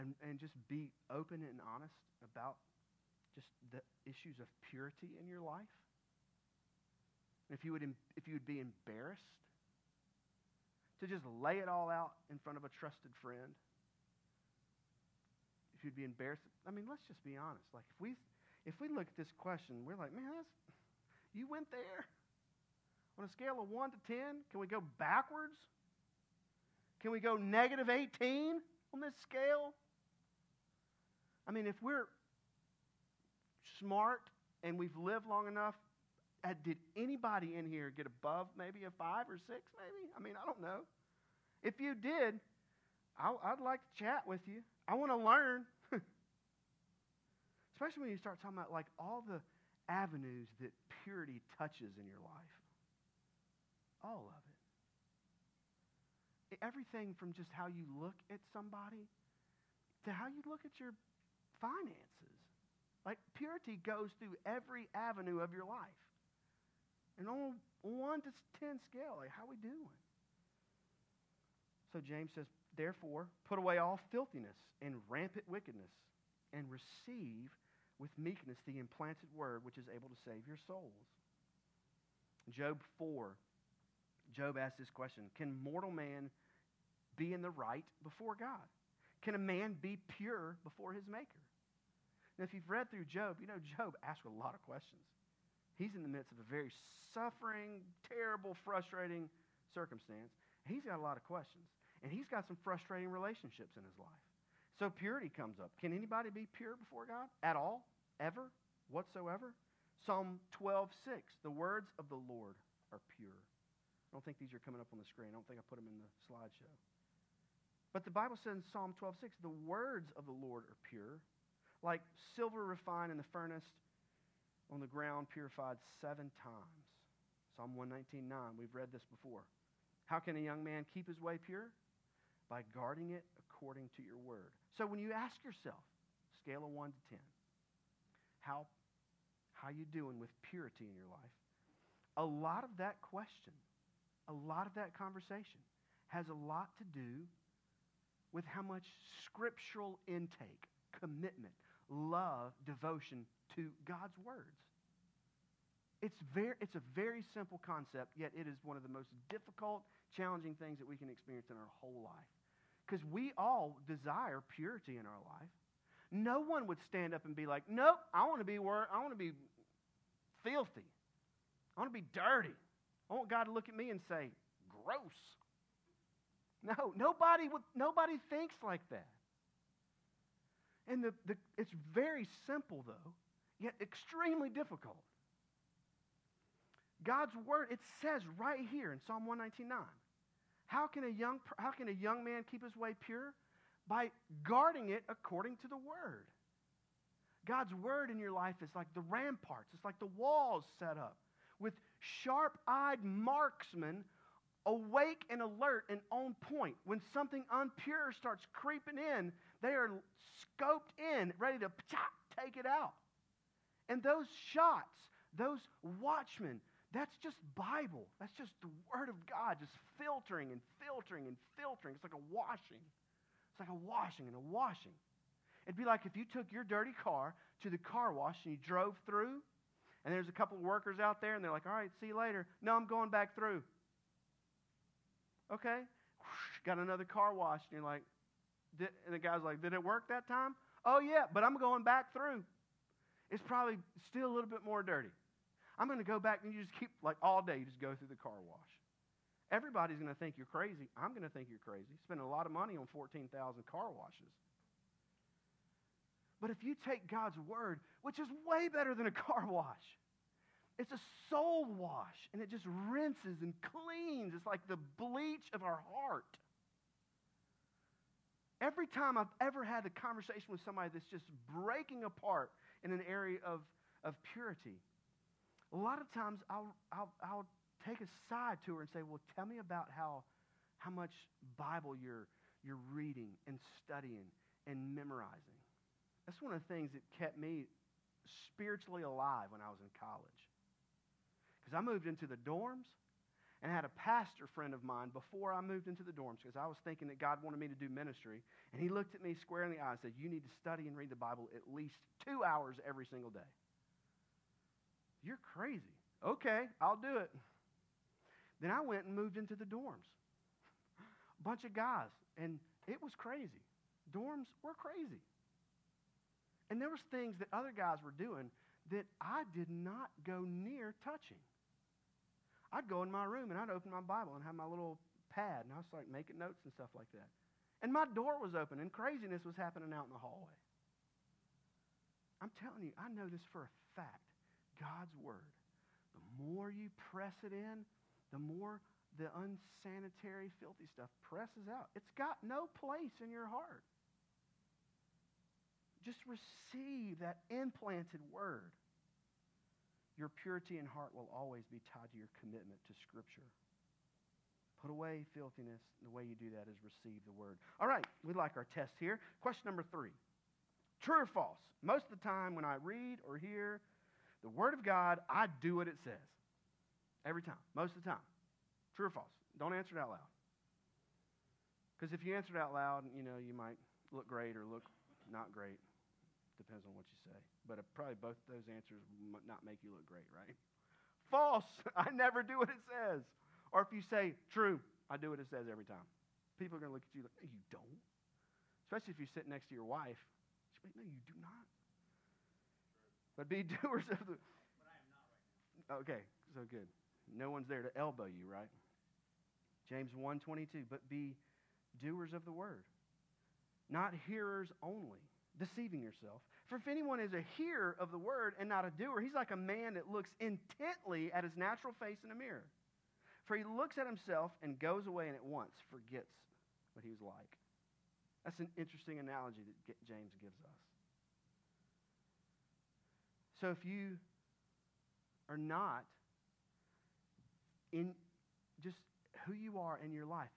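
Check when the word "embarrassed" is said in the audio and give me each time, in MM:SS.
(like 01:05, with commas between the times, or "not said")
00:08, 00:16.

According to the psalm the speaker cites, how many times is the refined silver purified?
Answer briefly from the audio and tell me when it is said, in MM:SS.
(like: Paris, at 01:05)
7, at 02:06.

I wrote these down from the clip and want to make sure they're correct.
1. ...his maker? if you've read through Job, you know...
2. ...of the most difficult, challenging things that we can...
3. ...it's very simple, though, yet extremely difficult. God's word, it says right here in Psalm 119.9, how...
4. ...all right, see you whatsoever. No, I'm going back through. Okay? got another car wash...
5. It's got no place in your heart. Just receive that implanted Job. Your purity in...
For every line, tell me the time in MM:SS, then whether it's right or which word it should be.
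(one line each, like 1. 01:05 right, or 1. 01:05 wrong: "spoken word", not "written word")
1. 01:30 right
2. 02:38 right
3. 03:01 right
4. 03:51 wrong: "later", not "whatsoever"
5. 05:41 wrong: "Word", not "Job".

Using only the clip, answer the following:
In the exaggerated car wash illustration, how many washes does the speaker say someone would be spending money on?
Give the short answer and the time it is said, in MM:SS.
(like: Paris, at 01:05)
14,000, at 04:12.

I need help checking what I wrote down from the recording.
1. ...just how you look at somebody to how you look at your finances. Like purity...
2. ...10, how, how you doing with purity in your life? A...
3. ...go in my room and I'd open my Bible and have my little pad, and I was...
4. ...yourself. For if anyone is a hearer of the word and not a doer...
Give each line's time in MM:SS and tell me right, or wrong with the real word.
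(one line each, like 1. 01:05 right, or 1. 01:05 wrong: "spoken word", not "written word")
1. 00:57 right
2. 02:17 right
3. 05:22 right
4. 06:46 right.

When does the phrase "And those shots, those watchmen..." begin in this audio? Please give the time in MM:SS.
03:33.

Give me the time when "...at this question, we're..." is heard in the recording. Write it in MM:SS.
00:19.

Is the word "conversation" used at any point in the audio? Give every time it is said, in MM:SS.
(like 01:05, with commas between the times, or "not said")
02:24, 04:29.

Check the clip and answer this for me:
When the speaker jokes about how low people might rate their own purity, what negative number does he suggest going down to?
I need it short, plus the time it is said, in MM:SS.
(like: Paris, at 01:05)
-18, at 00:27.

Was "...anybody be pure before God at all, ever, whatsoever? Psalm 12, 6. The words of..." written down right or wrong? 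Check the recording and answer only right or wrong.
right.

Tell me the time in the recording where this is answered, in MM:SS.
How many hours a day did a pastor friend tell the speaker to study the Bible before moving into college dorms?
05:02.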